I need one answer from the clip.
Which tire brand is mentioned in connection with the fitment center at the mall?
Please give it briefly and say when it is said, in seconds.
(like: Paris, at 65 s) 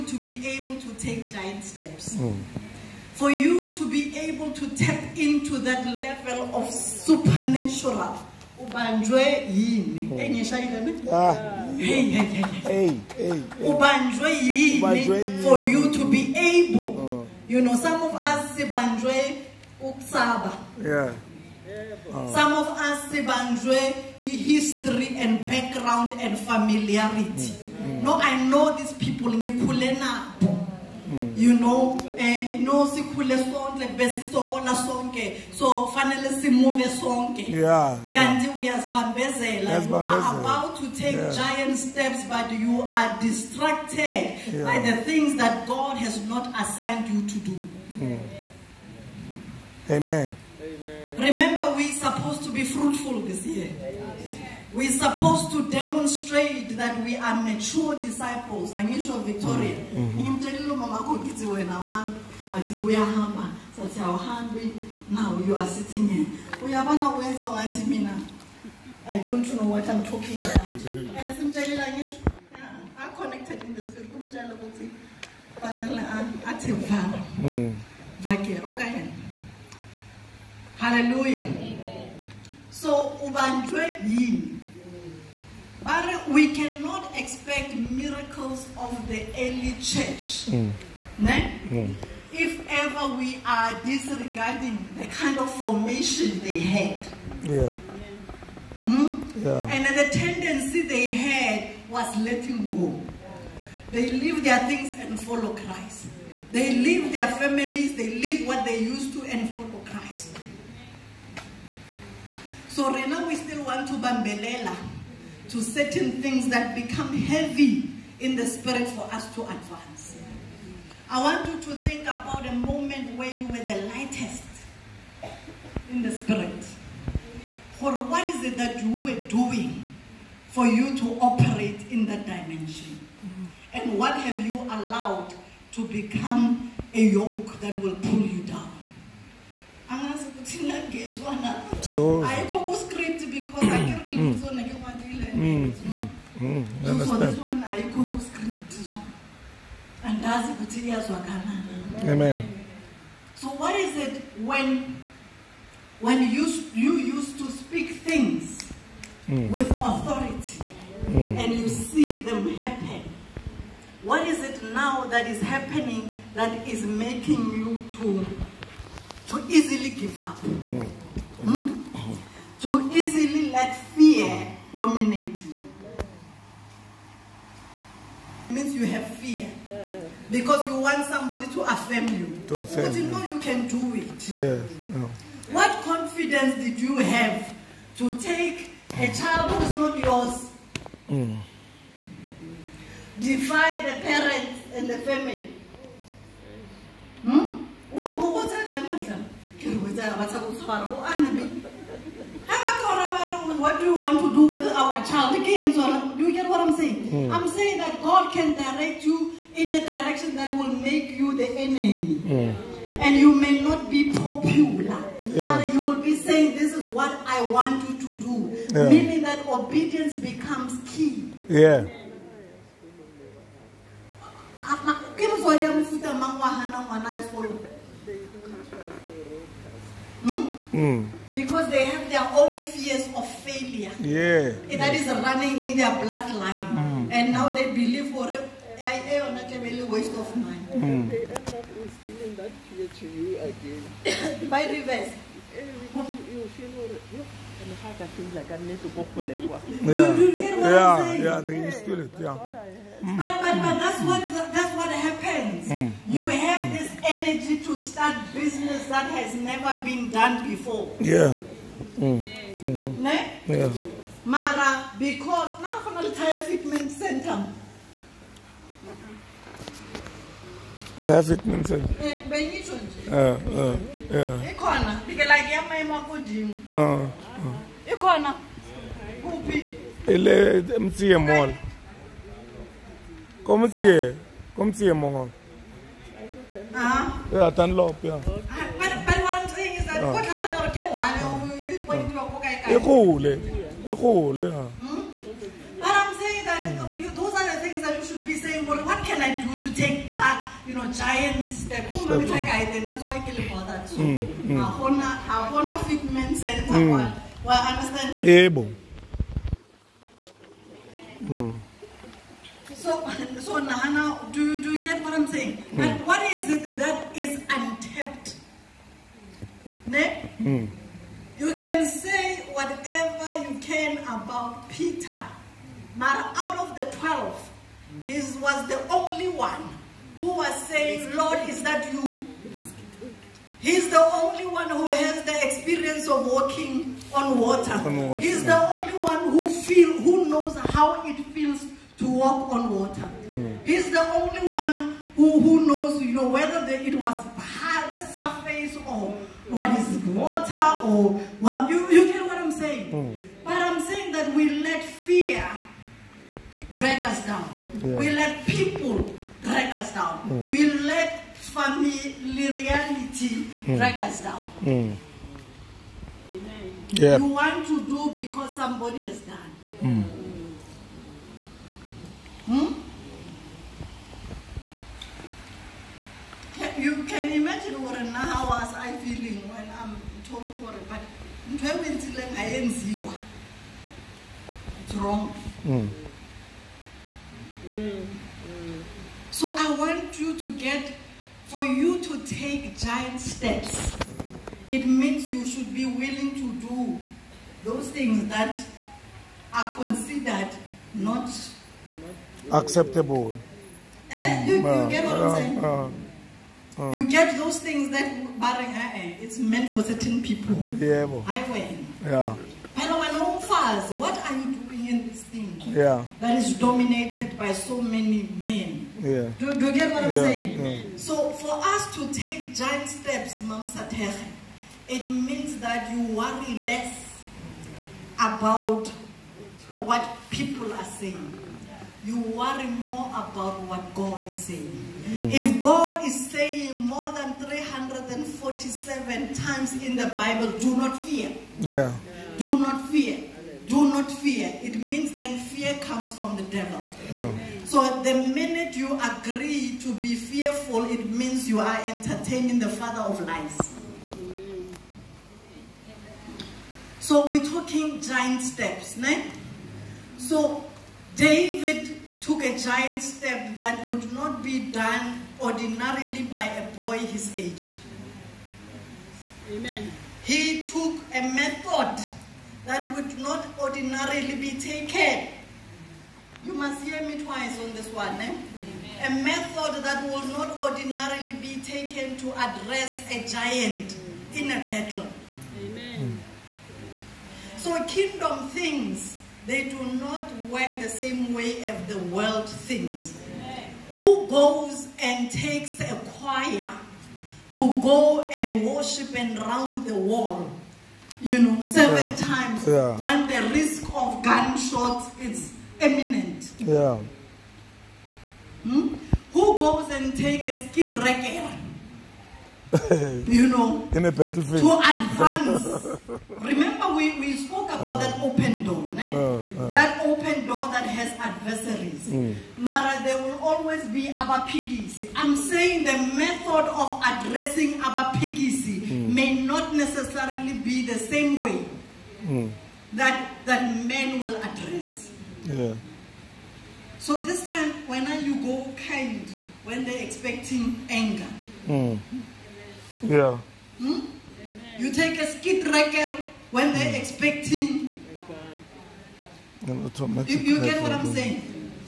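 Dunlop, at 287 s.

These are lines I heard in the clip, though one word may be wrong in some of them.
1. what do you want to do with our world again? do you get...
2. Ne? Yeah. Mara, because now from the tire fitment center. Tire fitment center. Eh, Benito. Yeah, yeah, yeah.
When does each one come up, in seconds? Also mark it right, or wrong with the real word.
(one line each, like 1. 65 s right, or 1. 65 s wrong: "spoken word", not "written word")
1. 203 s wrong: "child", not "world"
2. 263 s right.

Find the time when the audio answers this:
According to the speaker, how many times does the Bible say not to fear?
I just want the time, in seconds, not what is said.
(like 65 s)
437 s.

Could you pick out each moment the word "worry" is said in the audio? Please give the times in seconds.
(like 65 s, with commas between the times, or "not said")
426 s, 432 s.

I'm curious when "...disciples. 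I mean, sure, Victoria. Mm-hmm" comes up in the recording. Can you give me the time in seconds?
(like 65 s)
58 s.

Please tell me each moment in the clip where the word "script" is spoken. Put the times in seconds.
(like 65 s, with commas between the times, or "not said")
142 s, 152 s.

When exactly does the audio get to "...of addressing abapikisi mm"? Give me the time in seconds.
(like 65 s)
526 s.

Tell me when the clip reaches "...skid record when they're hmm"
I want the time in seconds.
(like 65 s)
545 s.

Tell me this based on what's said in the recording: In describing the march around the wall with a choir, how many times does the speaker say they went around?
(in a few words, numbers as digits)
7.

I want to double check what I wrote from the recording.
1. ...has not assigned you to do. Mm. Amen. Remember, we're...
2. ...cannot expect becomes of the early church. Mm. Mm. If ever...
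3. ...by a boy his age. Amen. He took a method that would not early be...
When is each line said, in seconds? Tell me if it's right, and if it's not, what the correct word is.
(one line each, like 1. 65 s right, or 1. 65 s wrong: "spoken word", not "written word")
1. 45 s right
2. 86 s wrong: "miracles", not "becomes"
3. 466 s wrong: "ordinarily", not "early".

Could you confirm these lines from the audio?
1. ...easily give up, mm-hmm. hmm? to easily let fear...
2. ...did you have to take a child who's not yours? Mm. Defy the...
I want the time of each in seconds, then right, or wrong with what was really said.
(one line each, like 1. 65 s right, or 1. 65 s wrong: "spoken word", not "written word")
1. 169 s right
2. 186 s right.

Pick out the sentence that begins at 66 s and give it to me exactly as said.
We have Uyabona wenza ngathi mina I don't know what I'm talking about.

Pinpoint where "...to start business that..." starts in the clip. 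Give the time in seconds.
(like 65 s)
257 s.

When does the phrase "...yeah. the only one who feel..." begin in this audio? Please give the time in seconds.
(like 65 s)
338 s.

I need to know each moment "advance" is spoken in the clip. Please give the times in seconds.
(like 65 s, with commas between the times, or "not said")
119 s, 514 s.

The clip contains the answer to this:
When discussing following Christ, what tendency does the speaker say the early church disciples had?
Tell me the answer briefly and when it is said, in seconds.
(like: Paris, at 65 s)
Letting go, at 102 s.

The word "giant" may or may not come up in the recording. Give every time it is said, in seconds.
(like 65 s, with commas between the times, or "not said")
1 s, 41 s, 300 s, 392 s, 422 s, 457 s, 462 s, 483 s.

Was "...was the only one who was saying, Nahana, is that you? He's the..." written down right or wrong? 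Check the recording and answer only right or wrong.
wrong.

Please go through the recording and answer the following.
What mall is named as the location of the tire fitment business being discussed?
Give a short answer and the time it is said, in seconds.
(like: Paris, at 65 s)
MCM mall, at 280 s.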